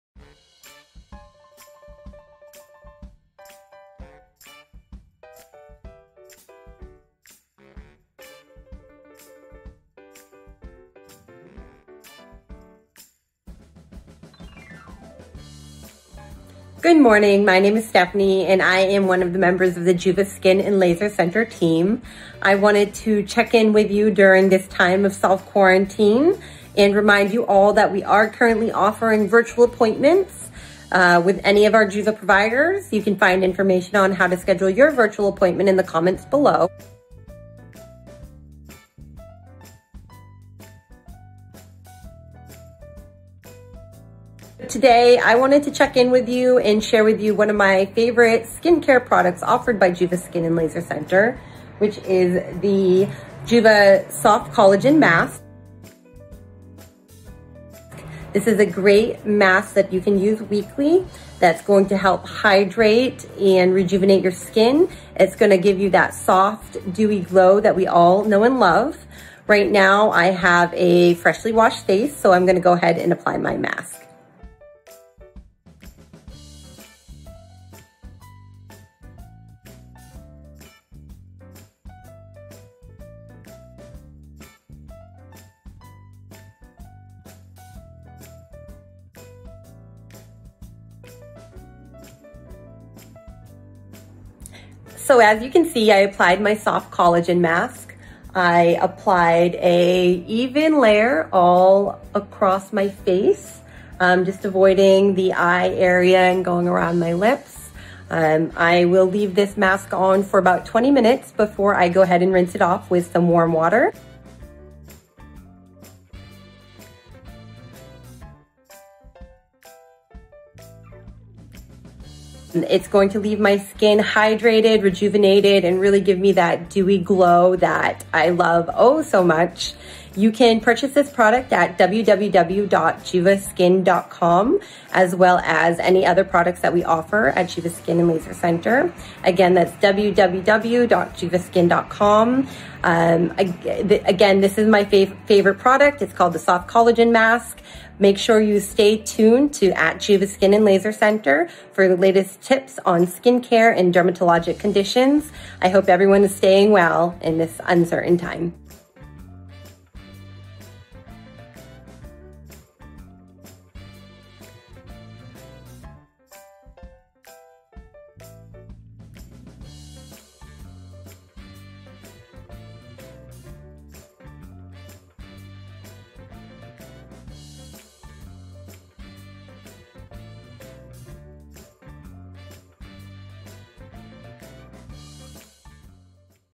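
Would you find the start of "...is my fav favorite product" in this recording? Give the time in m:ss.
2:24.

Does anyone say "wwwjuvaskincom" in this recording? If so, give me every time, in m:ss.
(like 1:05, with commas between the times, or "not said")
2:11, 2:19.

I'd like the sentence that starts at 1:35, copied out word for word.
So as you can see, I applied my soft collagen mask.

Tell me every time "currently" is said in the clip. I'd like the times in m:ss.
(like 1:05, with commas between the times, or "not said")
0:28.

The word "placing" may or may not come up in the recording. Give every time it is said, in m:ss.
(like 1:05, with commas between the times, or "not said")
not said.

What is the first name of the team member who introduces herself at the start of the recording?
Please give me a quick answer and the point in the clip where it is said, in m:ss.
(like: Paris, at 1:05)
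Stephanie, at 0:17.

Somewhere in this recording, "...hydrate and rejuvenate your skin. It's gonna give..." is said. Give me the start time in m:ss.
1:02.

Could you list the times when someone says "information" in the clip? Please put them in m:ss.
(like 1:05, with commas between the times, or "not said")
0:33.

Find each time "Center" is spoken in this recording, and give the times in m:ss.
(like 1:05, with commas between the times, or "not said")
0:21, 0:50, 2:18, 2:30.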